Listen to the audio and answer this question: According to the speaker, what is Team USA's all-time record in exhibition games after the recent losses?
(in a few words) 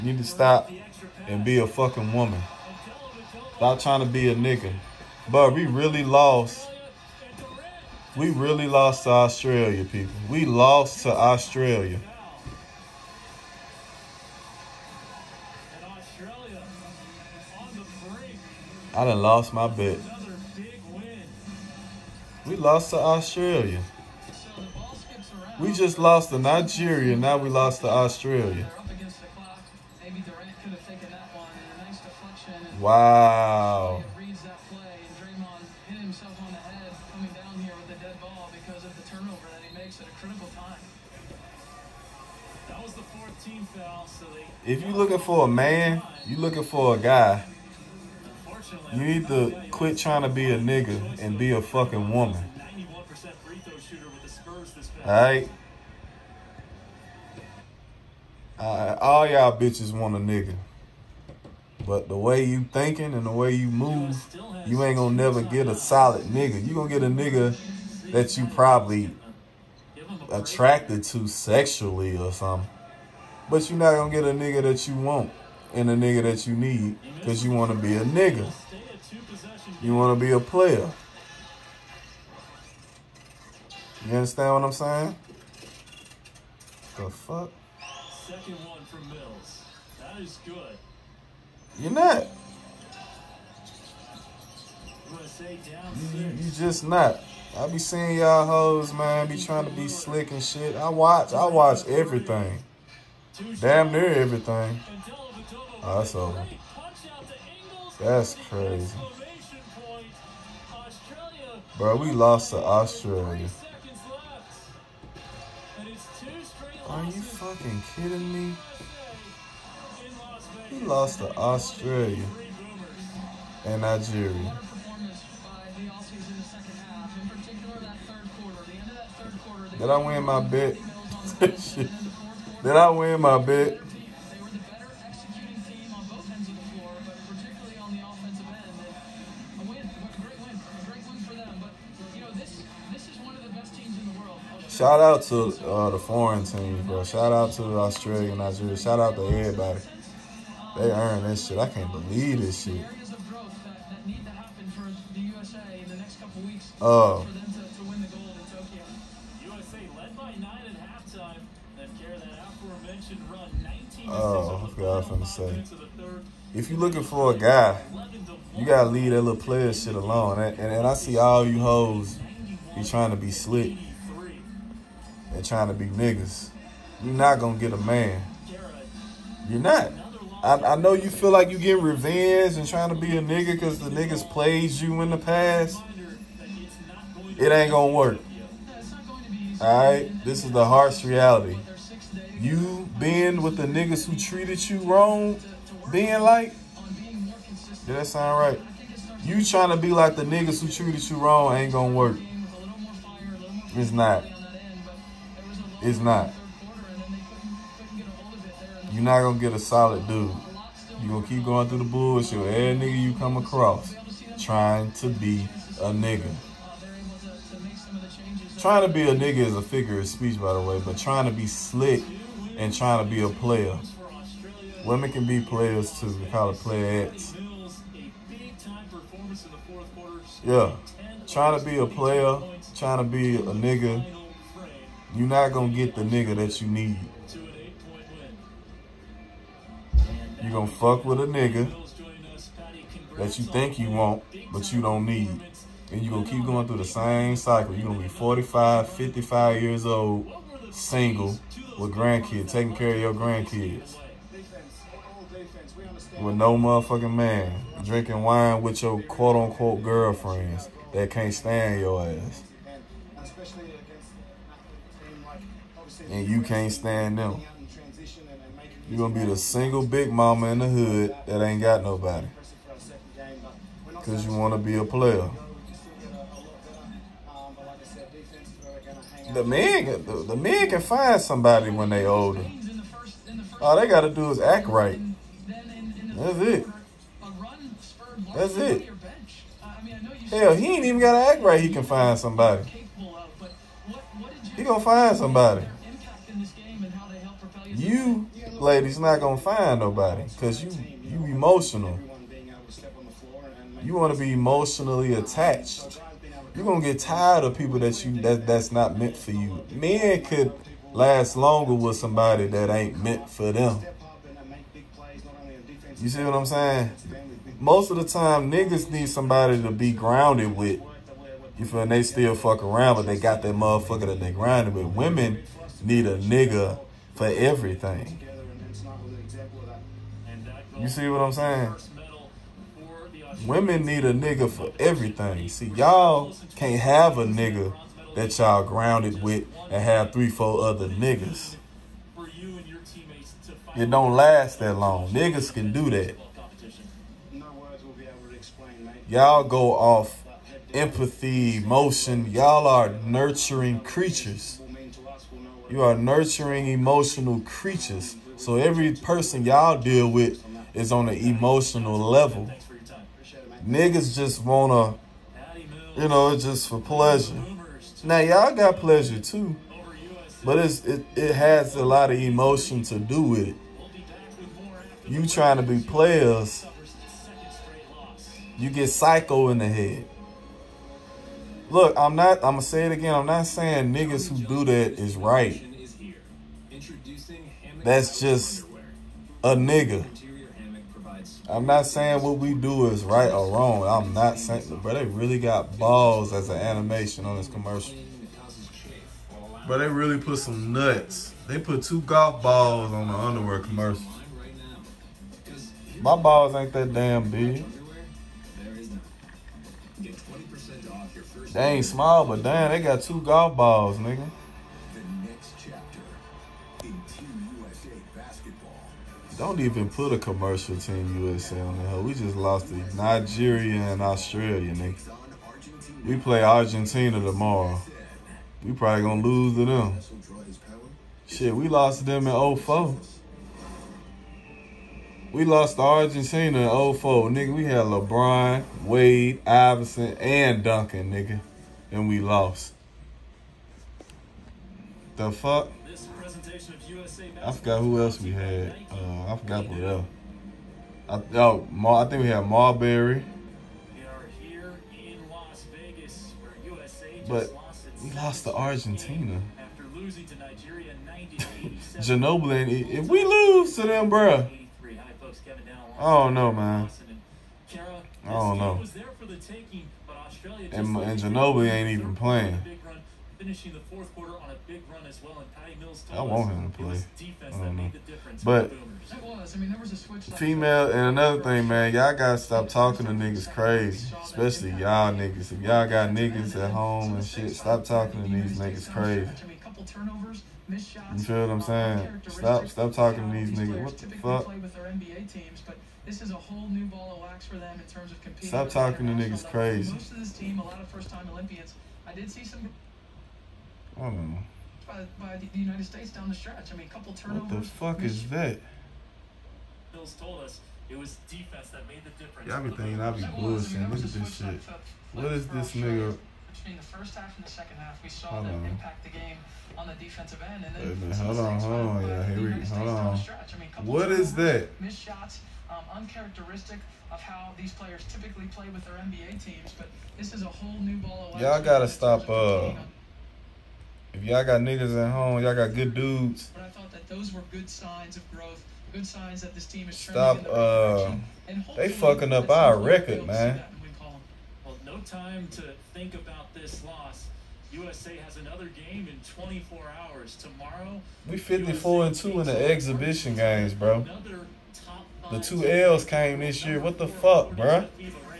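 54 and 2.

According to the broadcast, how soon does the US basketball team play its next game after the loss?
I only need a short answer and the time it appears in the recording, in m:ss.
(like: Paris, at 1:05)
24 hours, at 9:09.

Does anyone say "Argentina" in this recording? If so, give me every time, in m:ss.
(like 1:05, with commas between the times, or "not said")
7:06, 7:15, 7:38.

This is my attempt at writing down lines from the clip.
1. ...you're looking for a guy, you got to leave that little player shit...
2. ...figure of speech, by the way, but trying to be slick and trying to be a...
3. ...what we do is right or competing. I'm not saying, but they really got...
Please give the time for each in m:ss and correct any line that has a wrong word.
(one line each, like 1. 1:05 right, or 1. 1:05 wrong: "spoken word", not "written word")
1. 2:46 right
2. 3:39 right
3. 6:32 wrong: "wrong", not "competing".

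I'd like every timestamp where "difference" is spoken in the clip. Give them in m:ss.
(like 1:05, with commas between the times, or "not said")
7:57, 8:32.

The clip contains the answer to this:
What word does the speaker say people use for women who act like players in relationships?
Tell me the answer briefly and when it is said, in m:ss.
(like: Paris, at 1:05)
playettes, at 3:46.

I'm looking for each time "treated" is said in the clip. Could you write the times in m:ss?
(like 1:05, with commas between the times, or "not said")
3:14, 3:20.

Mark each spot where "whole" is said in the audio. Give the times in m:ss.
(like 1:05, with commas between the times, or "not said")
8:16, 8:50.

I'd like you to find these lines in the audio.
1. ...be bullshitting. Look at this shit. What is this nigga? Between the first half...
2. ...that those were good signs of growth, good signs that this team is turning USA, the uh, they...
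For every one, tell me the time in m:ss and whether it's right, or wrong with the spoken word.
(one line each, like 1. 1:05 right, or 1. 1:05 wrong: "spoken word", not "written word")
1. 8:33 right
2. 8:56 wrong: "Stop", not "USA".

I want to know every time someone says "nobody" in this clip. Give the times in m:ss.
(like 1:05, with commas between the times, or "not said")
4:31, 4:59.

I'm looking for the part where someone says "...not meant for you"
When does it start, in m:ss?
5:08.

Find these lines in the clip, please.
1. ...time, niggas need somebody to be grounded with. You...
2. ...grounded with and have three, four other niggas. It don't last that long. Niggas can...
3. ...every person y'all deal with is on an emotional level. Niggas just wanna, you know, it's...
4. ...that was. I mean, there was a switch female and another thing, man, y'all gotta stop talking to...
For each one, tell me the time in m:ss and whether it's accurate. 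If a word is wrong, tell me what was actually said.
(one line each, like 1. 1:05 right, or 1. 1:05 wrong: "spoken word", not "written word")
1. 5:18 right
2. 5:38 right
3. 5:58 right
4. 7:59 right.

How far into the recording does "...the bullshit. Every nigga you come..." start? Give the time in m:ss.
3:31.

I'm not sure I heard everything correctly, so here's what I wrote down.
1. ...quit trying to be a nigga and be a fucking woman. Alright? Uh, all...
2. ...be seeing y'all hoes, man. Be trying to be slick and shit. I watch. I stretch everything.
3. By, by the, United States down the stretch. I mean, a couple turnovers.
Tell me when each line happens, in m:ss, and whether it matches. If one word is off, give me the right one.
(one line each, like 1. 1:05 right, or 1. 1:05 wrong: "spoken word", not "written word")
1. 0:49 right
2. 1:37 wrong: "watch", not "stretch"
3. 8:24 right.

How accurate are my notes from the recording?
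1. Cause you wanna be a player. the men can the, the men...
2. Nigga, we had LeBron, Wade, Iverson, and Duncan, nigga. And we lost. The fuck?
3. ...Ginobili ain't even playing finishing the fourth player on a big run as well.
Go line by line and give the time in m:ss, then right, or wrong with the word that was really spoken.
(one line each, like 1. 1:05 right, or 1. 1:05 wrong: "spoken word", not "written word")
1. 4:33 right
2. 7:17 right
3. 7:51 wrong: "quarter", not "player".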